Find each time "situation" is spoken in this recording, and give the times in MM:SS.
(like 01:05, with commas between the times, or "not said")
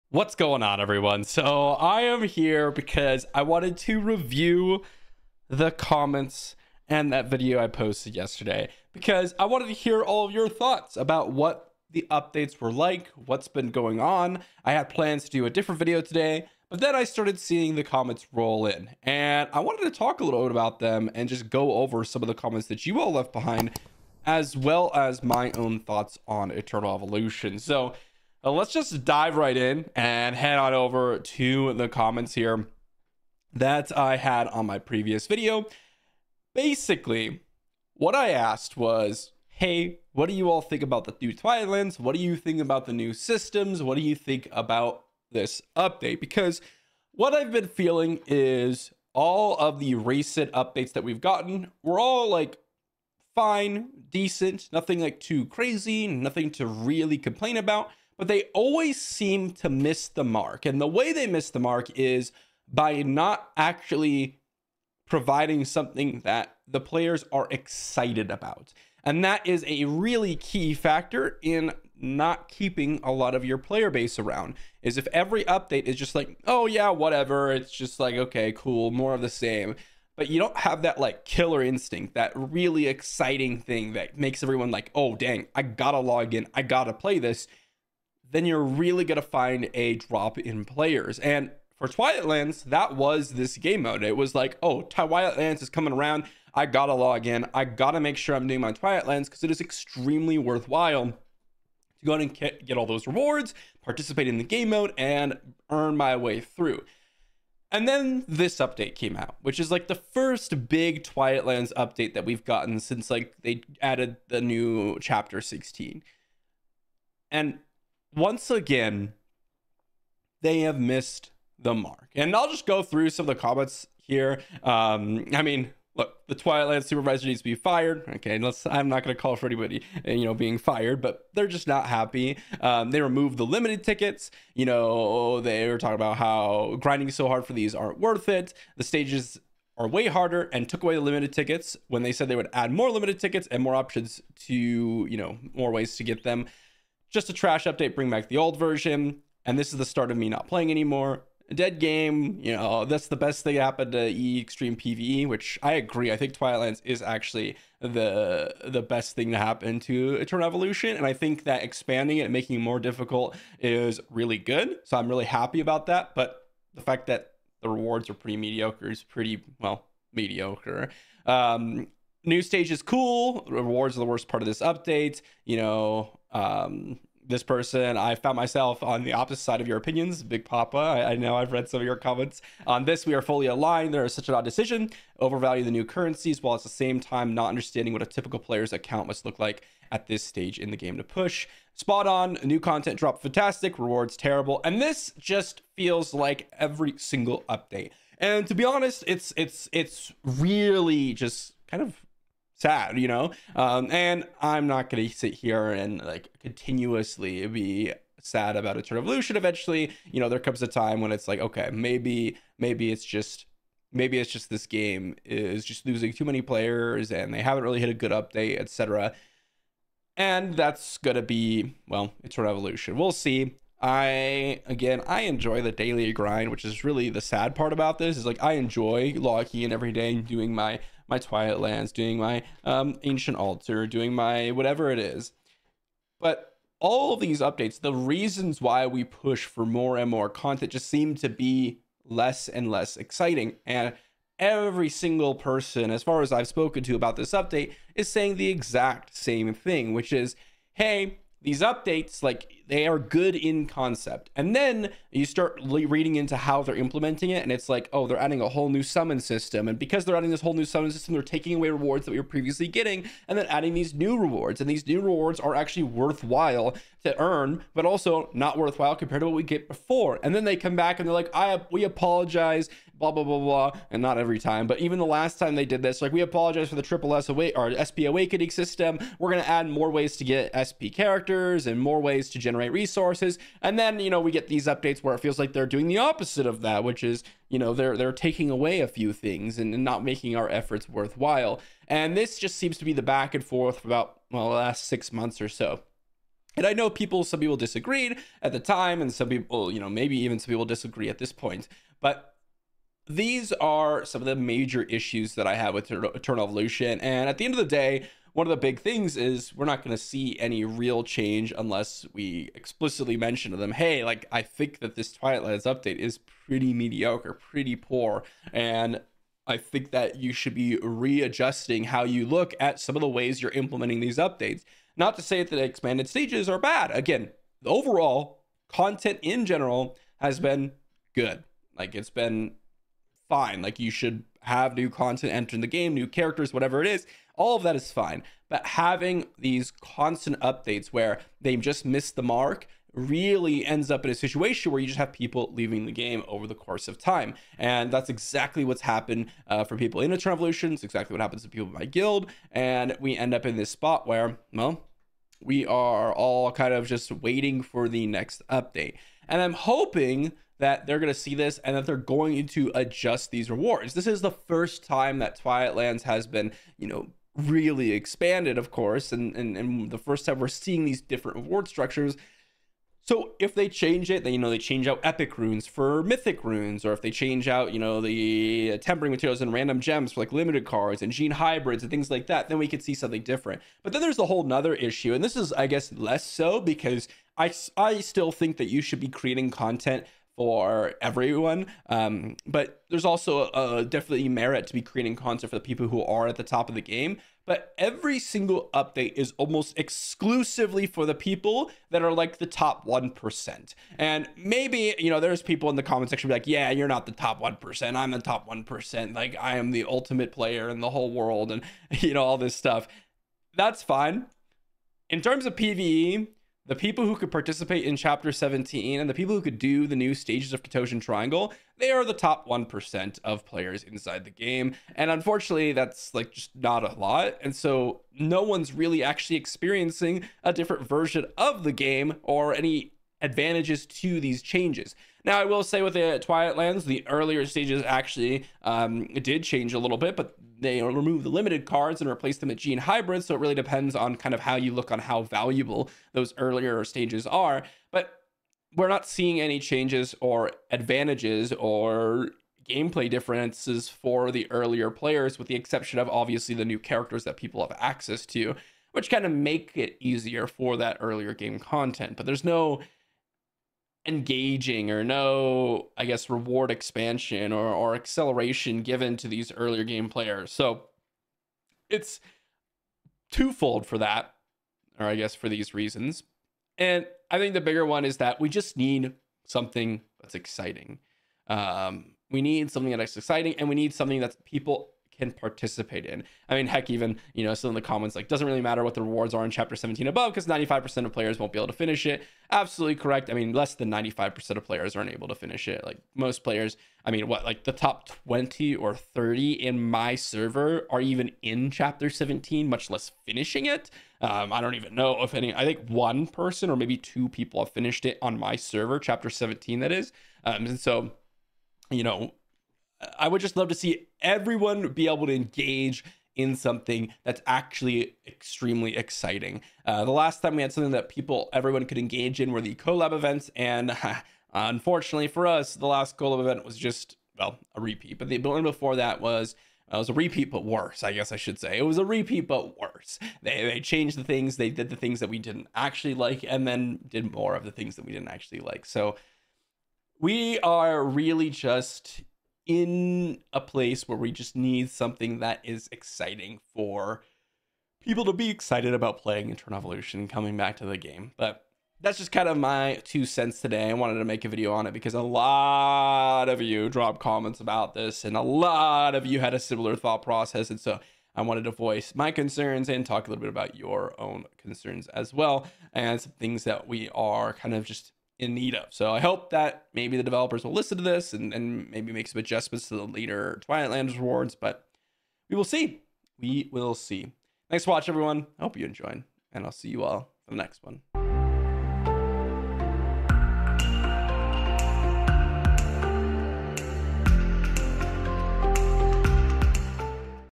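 05:44.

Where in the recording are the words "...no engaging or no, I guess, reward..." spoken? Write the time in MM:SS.
07:42.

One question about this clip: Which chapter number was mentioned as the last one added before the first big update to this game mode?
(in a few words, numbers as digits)
16.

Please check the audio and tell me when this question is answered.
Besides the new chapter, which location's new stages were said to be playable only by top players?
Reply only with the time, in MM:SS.
07:00.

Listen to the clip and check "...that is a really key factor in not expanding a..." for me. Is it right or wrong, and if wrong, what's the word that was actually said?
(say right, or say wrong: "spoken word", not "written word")
wrong: "keeping", not "expanding".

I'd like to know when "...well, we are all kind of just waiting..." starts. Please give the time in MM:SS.
05:54.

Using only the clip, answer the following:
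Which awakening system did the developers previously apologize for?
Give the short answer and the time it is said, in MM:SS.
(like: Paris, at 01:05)
SP awakening, at 04:37.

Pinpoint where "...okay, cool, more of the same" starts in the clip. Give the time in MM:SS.
01:18.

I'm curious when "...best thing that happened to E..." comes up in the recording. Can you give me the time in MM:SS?
02:33.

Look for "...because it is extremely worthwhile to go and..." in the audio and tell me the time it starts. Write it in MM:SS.
01:39.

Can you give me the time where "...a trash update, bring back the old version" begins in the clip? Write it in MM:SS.
02:27.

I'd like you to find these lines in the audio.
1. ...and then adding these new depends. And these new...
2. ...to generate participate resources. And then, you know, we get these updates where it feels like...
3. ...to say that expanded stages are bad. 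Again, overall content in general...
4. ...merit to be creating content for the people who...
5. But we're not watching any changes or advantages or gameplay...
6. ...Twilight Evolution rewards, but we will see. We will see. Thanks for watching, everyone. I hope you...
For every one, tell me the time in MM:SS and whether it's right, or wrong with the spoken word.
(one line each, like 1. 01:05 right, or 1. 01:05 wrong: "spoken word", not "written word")
1. 04:23 wrong: "rewards", not "depends"
2. 04:42 wrong: "generate", not "participate"
3. 05:25 right
4. 06:34 right
5. 07:27 wrong: "seeing", not "watching"
6. 09:33 wrong: "Lands", not "Evolution".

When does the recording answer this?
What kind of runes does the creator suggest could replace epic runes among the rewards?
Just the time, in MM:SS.
06:16.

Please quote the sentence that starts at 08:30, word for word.
Um, and so, you know, I would just love to see everyone be able to engage in something that's actually extremely exciting.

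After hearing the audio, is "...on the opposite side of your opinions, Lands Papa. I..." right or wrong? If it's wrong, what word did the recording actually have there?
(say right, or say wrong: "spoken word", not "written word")
wrong: "Big", not "Lands".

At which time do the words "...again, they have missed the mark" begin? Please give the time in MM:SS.
01:58.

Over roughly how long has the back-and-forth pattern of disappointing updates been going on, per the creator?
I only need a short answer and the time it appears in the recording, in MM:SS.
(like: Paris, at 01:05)
6 months, at 04:54.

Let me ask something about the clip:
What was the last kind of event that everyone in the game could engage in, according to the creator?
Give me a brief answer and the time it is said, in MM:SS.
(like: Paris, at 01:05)
collab events, at 08:42.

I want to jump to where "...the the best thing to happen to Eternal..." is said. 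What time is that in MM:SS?
02:37.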